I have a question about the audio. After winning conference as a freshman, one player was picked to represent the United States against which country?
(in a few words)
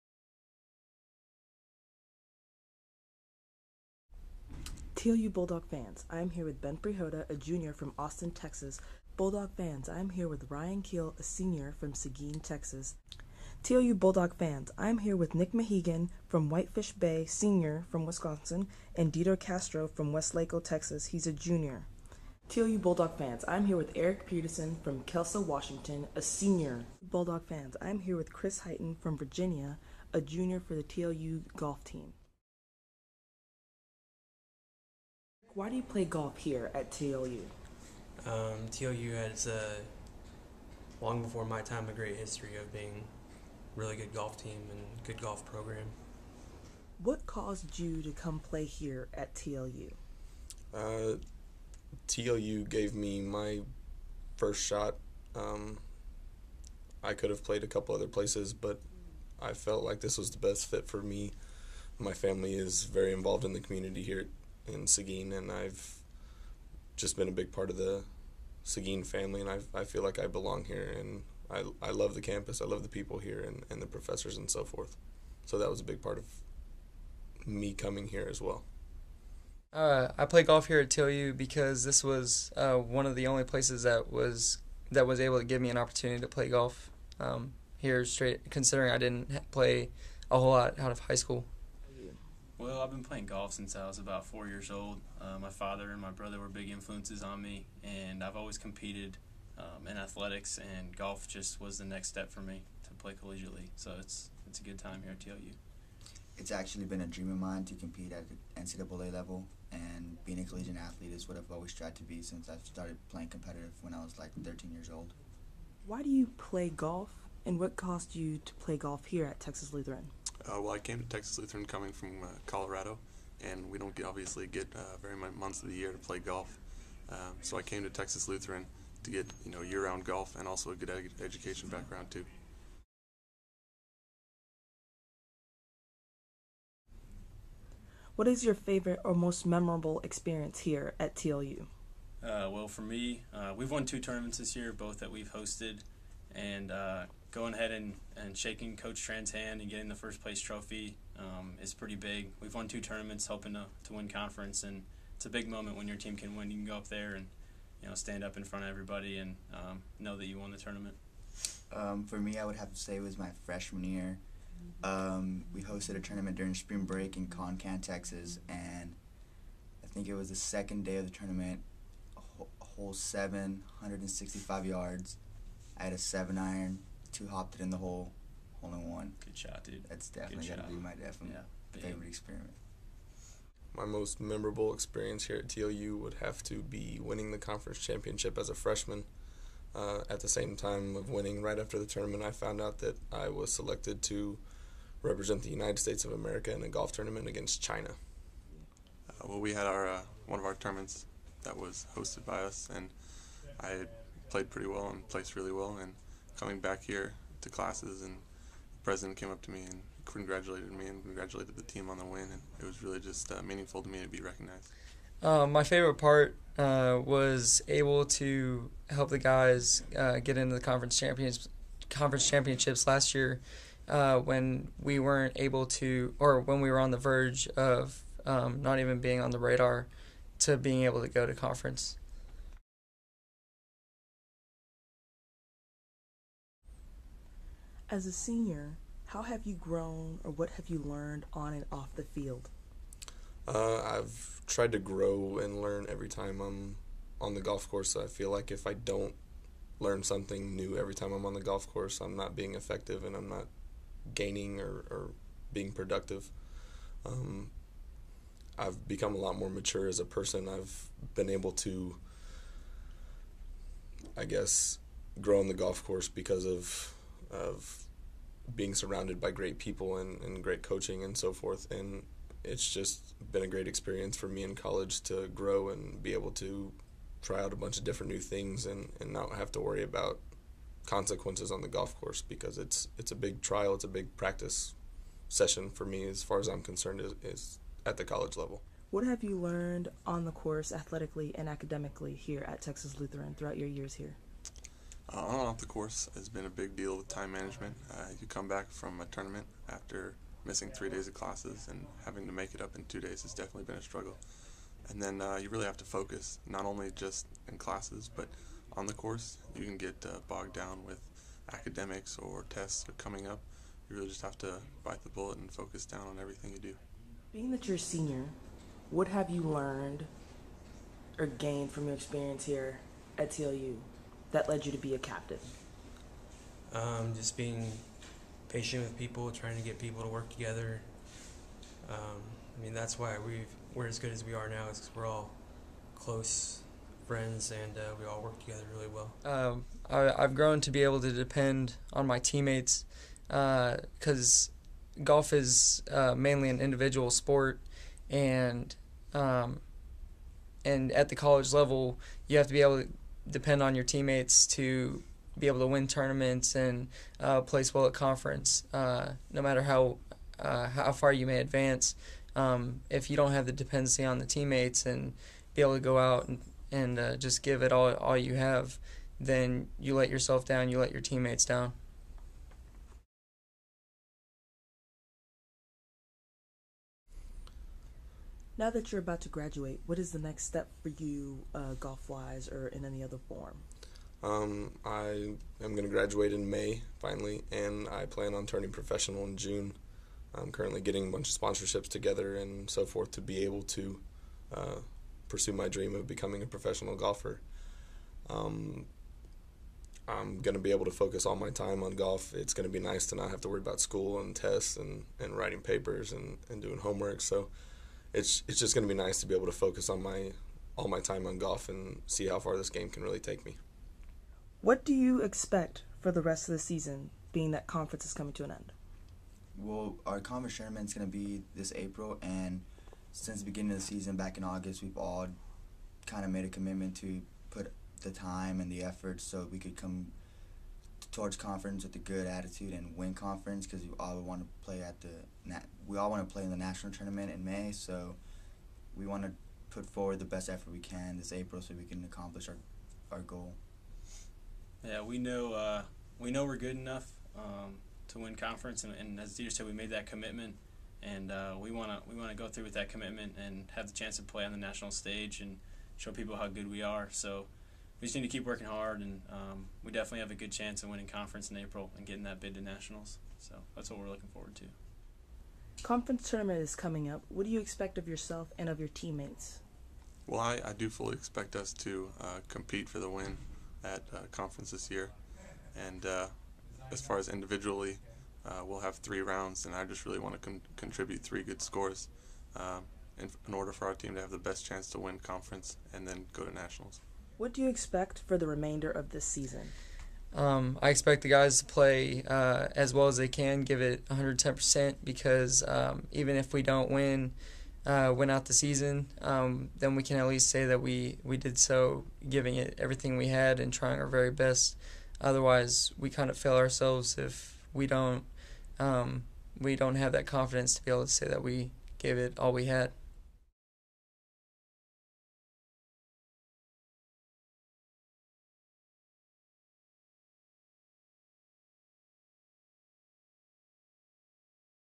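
China.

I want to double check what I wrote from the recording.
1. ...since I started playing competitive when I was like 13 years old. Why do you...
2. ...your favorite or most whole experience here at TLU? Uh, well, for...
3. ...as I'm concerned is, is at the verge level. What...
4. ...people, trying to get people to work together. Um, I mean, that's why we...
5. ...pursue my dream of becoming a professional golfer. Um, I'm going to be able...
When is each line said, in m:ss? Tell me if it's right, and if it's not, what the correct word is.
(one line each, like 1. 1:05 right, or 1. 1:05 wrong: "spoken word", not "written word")
1. 1:52 right
2. 2:18 wrong: "memorable", not "whole"
3. 4:46 wrong: "college", not "verge"
4. 5:28 right
5. 6:35 right.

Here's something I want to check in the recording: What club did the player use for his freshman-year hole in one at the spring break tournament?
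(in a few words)
Seven iron.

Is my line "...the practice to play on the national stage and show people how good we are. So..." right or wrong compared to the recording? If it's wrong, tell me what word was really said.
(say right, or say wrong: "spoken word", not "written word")
wrong: "chance", not "practice".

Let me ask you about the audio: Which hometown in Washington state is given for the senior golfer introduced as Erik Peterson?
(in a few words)
Kelso.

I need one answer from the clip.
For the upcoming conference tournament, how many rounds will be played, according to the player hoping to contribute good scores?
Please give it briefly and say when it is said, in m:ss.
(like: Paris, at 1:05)
3, at 7:58.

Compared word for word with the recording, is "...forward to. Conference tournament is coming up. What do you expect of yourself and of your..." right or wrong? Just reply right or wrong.
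right.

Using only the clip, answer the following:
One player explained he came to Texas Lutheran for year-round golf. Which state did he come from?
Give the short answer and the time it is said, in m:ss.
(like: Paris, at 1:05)
Colorado, at 2:02.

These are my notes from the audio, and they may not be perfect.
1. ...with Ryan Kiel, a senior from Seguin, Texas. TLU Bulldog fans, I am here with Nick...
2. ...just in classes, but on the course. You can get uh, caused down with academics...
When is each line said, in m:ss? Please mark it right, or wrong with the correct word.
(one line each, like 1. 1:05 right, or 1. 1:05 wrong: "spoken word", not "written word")
1. 0:10 right
2. 5:06 wrong: "bogged", not "caused".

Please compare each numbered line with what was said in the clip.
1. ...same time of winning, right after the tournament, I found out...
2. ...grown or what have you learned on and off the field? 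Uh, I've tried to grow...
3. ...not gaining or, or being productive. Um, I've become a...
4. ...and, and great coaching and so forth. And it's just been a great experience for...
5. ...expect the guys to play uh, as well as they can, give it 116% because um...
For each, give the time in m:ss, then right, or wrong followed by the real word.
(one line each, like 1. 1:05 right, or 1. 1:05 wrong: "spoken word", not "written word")
1. 3:10 right
2. 3:59 right
3. 4:13 right
4. 4:29 right
5. 8:10 wrong: "110", not "116".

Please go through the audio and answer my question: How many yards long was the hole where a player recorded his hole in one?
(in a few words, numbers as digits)
165.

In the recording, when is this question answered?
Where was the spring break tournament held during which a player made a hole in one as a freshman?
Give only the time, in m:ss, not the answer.
2:47.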